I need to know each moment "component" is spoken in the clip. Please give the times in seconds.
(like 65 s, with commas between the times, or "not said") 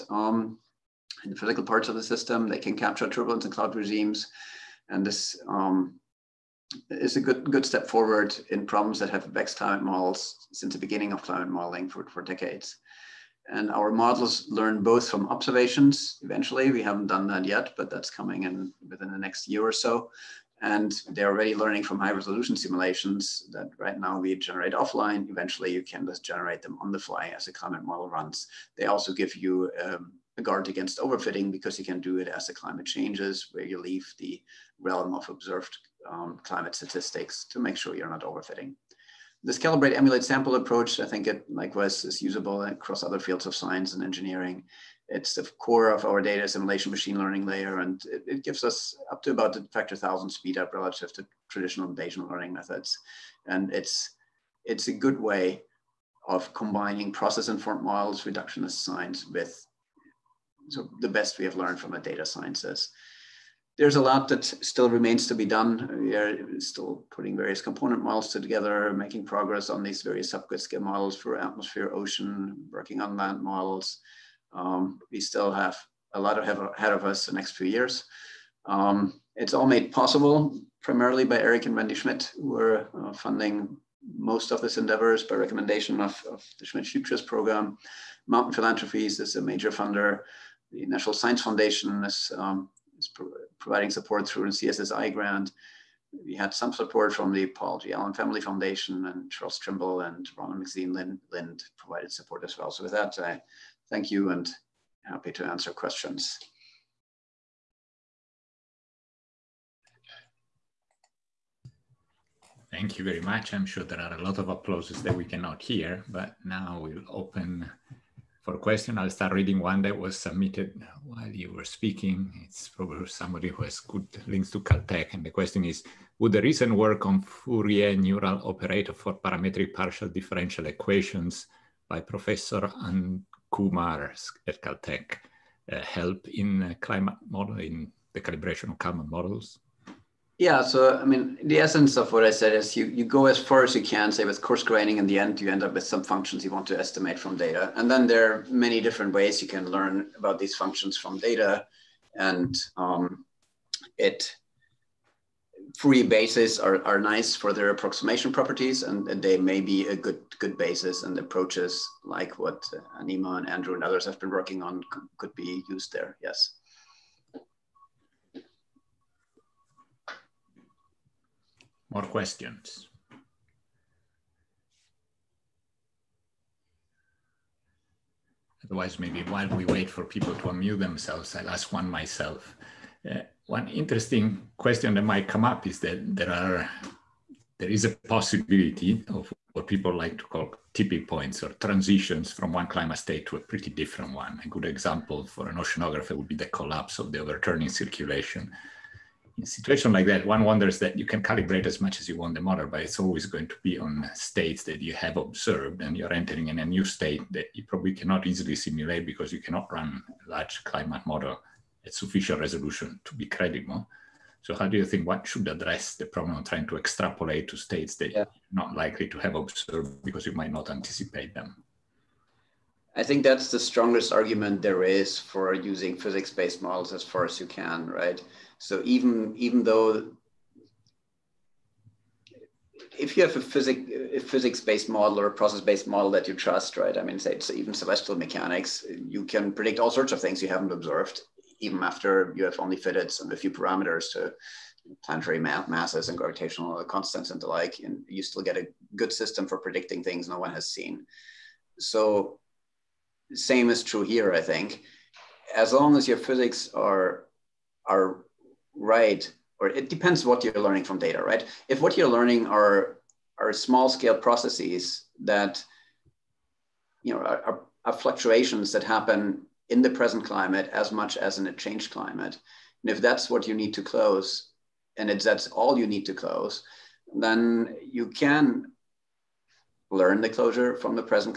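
67 s.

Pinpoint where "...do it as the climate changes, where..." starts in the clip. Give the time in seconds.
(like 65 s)
32 s.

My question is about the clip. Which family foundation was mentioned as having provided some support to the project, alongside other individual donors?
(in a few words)
Paul G. Allen Family Foundation.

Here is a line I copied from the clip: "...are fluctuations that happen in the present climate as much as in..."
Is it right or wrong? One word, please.
right.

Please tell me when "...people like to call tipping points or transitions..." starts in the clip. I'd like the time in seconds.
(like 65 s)
189 s.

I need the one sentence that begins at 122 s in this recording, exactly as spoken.
It's probably somebody who has good links to Caltech.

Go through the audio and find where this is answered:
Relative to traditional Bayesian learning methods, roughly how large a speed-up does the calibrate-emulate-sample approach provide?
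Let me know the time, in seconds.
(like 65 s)
49 s.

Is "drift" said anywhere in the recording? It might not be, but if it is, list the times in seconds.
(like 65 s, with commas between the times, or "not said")
not said.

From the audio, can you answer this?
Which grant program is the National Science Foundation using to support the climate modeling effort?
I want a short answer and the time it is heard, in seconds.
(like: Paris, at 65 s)
CSSI grant, at 94 s.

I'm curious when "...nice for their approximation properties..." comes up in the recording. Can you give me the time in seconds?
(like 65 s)
157 s.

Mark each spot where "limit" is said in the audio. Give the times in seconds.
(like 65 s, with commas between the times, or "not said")
not said.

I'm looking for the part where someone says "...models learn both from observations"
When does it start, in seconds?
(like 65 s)
13 s.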